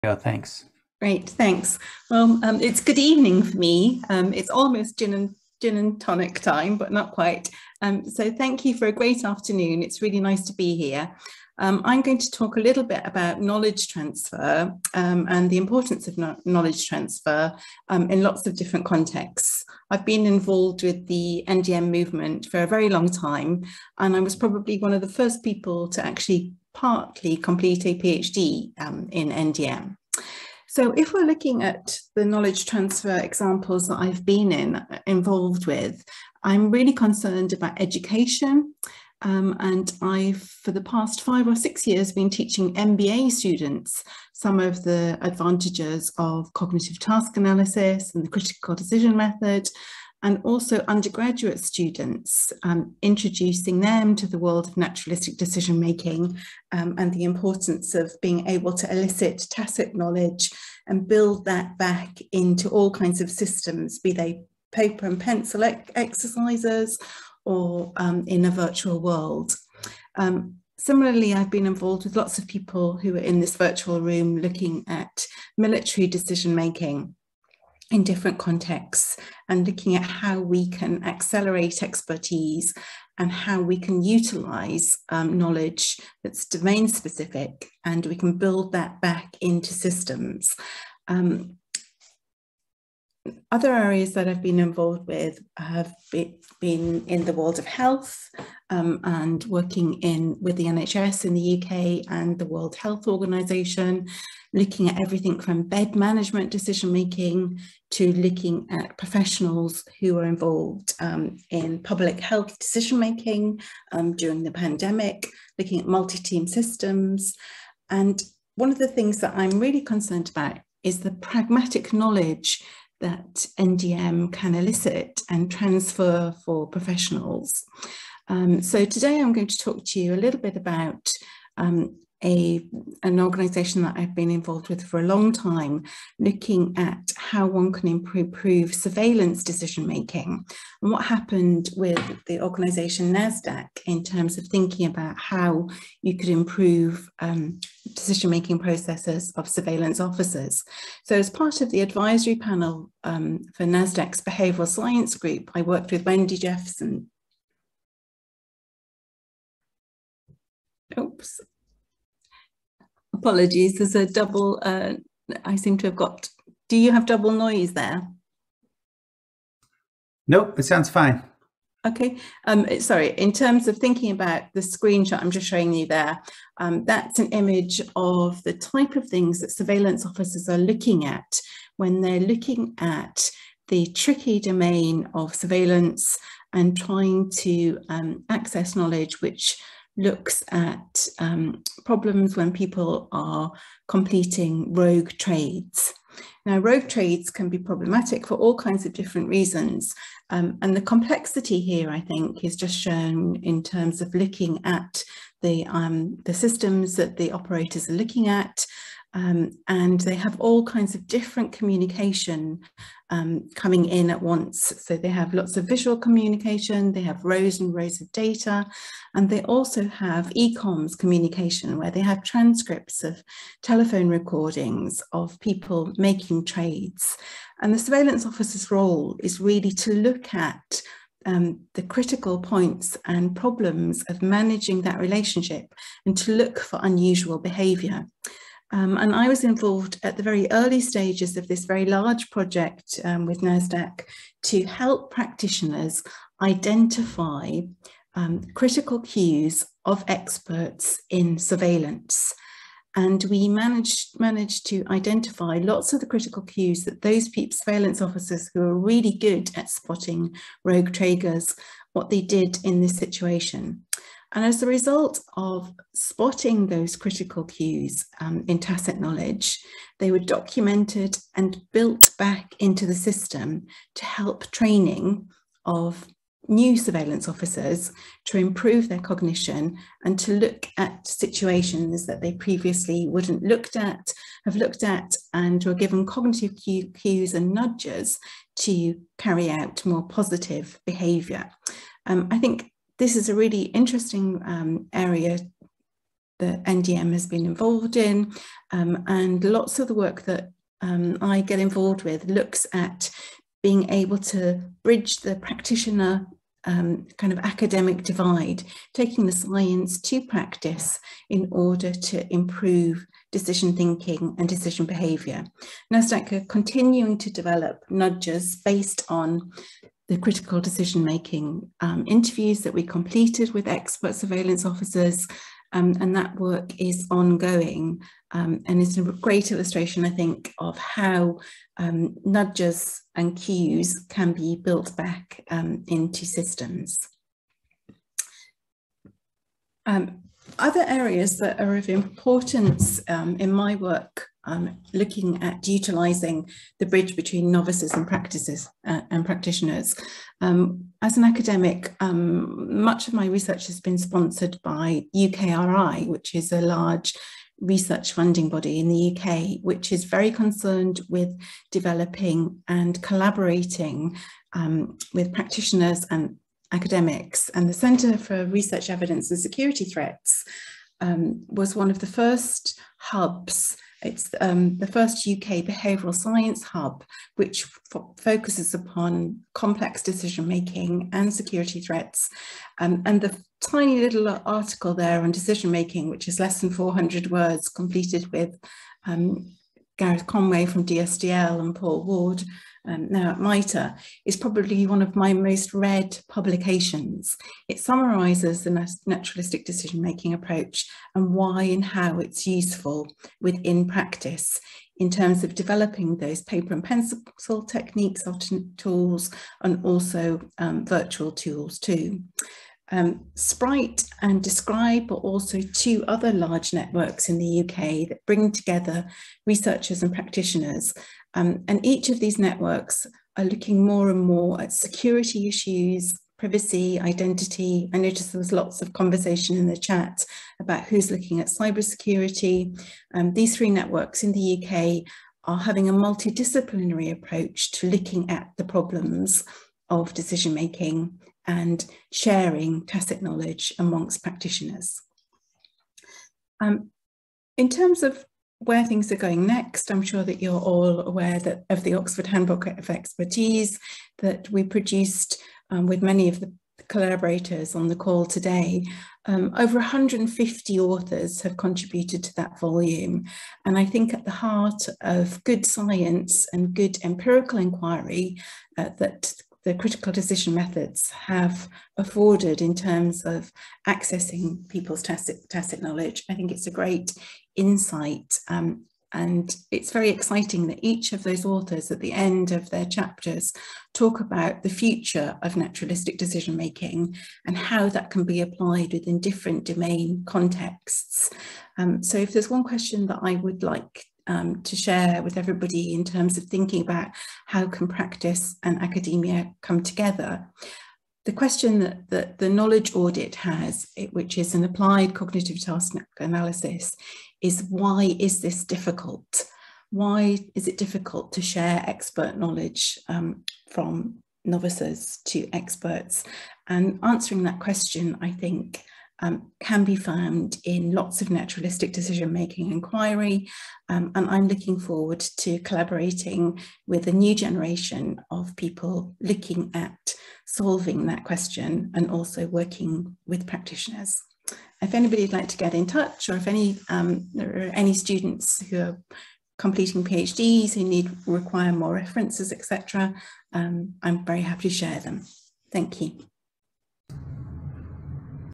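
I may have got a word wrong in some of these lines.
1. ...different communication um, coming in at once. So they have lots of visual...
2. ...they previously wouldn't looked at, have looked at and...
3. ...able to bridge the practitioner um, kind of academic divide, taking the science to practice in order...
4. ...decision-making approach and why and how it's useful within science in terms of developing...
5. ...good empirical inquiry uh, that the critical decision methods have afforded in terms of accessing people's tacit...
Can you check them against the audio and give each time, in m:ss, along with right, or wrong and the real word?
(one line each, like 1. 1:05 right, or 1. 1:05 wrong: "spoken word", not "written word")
1. 3:31 right
2. 4:42 right
3. 5:03 right
4. 6:39 wrong: "practice", not "science"
5. 7:46 right.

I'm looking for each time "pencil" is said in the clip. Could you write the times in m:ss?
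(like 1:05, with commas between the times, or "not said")
1:05, 6:46.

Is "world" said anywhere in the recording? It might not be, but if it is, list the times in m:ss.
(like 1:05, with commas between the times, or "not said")
0:54, 1:09, 1:37, 1:42.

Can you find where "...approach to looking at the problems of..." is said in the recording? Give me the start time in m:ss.
7:17.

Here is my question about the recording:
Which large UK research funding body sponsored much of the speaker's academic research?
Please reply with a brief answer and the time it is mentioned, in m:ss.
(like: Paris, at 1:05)
UKRI, at 5:55.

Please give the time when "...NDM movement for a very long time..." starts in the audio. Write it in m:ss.
0:21.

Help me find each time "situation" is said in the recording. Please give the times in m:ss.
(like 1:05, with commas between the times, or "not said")
4:22, 4:41.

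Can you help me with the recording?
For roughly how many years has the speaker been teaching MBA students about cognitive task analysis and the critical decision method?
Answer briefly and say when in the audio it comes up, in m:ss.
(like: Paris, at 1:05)
5 or 6, at 0:41.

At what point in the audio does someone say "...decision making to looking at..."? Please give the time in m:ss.
1:46.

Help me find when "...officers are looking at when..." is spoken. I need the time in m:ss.
3:00.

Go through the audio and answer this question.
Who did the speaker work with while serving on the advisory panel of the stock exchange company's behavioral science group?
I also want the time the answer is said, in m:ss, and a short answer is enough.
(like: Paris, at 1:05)
Wendy Jephson, at 2:36.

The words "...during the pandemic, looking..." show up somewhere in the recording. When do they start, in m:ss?
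1:54.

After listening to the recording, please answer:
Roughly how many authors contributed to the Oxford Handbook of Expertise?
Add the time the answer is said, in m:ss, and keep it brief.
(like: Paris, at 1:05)
over 150, at 7:39.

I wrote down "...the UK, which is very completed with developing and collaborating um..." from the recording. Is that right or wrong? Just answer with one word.
wrong.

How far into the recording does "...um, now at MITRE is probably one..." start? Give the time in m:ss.
6:32.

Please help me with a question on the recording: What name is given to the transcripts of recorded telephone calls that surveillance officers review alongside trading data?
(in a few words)
ecoms.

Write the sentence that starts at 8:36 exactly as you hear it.
And answering that question, I think, um, can be found in lots of naturalistic decision making inquiry.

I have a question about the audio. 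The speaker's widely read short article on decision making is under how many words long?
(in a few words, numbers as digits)
400.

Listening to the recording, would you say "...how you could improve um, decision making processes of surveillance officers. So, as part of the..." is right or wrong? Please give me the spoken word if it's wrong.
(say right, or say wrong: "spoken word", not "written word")
right.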